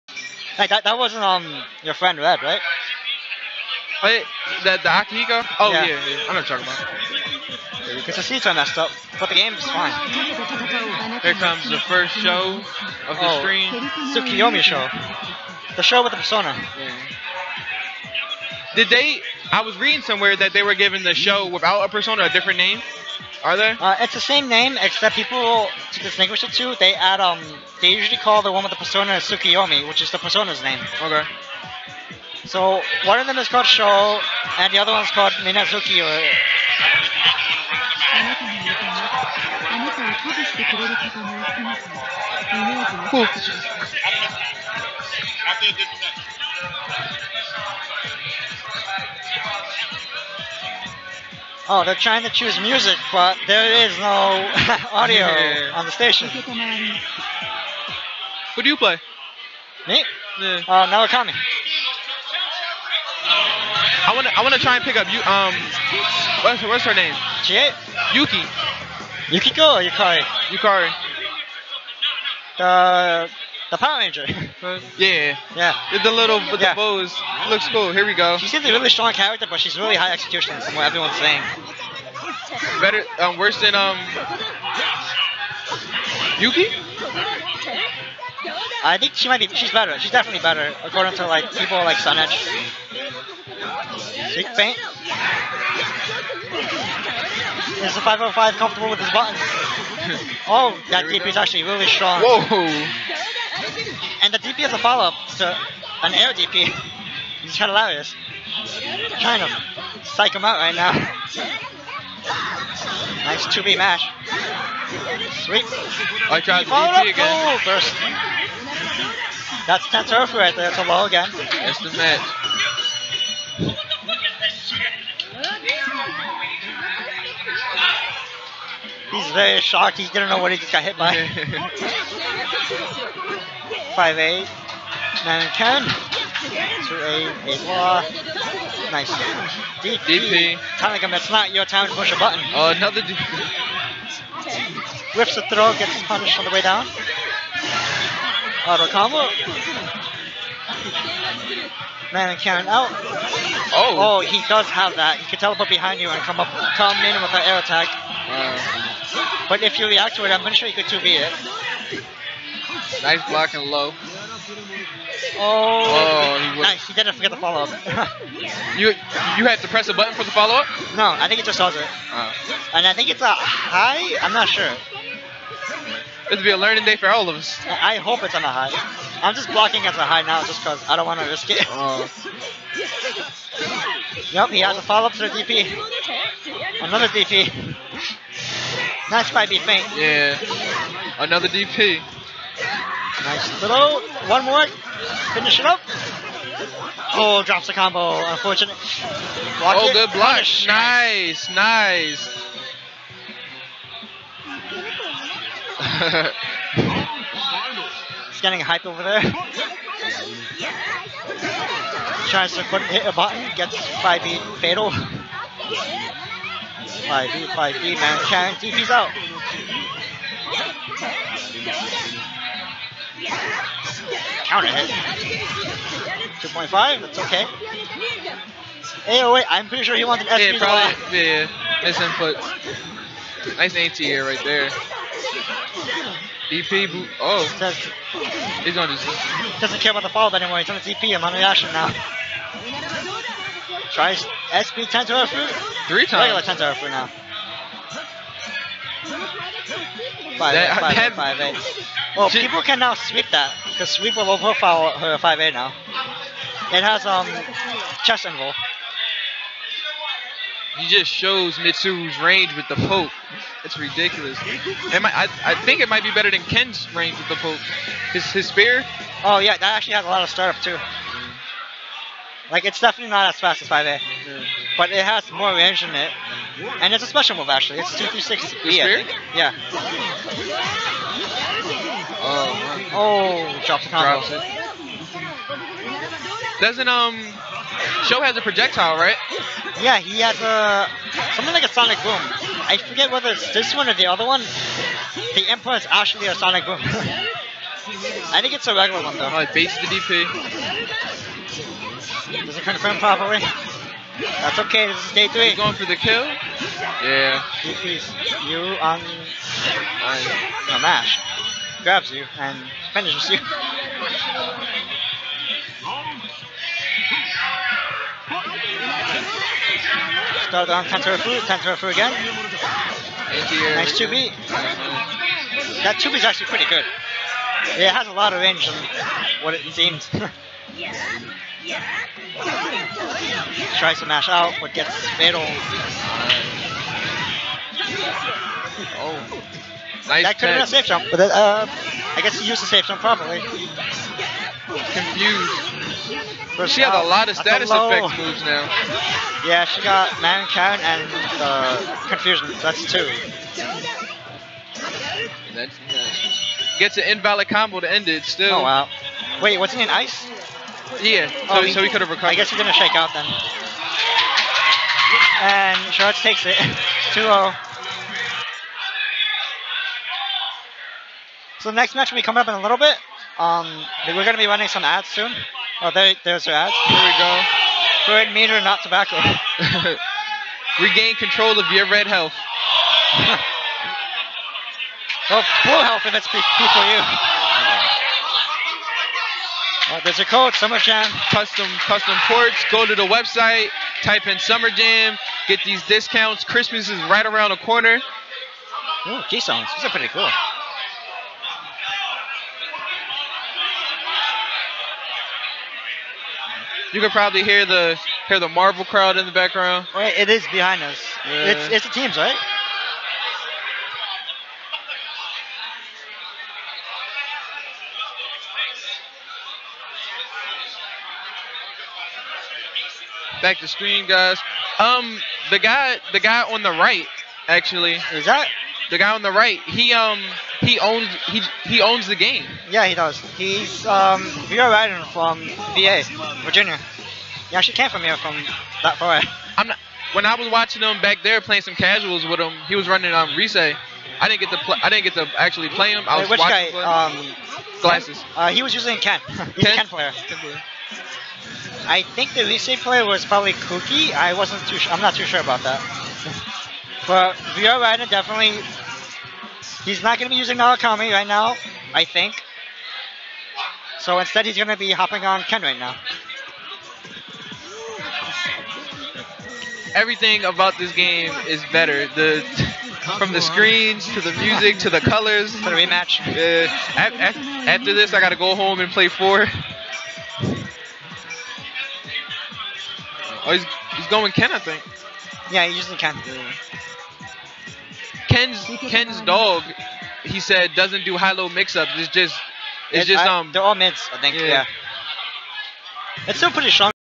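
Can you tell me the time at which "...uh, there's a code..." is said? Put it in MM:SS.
06:29.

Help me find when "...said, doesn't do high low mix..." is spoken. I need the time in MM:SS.
08:10.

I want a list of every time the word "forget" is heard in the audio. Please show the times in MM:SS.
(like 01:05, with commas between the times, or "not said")
02:47, 04:52.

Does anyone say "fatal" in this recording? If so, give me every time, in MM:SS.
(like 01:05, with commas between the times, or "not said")
03:34, 05:35.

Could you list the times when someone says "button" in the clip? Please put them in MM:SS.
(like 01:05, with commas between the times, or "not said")
01:39, 02:22, 02:49, 03:33.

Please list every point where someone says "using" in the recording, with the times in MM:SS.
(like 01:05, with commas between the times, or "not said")
07:28, 07:40.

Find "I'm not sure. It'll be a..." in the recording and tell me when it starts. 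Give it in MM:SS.
02:54.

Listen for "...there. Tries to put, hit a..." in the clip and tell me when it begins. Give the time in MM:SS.
03:29.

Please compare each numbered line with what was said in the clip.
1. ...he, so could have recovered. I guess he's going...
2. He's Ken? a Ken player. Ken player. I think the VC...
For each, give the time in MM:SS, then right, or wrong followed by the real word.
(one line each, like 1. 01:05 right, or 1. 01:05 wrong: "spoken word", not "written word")
1. 06:01 right
2. 07:29 right.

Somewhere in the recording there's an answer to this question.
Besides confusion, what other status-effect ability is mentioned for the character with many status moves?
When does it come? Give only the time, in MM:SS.
02:32.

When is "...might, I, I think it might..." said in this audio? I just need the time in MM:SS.
04:25.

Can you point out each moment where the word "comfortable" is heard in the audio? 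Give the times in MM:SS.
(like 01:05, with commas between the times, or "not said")
01:38.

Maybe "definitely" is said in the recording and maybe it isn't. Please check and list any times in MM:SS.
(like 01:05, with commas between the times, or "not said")
01:30, 04:32, 07:38.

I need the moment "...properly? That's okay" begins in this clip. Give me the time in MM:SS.
05:02.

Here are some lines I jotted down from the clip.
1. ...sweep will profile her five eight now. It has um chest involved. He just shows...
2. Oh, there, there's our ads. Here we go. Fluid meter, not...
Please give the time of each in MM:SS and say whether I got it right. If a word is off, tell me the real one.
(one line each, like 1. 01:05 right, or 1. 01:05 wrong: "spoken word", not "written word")
1. 04:13 right
2. 06:15 right.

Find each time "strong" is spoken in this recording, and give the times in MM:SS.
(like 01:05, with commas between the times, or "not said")
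01:18, 01:41, 08:16.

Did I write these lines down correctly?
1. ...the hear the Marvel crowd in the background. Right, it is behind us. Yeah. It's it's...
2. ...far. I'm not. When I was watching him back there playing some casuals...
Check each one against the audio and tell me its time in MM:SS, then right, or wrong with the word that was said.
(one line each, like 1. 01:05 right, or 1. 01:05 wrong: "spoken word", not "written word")
1. 06:47 right
2. 07:18 right.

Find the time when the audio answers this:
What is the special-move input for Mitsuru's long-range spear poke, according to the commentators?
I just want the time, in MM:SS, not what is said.
04:37.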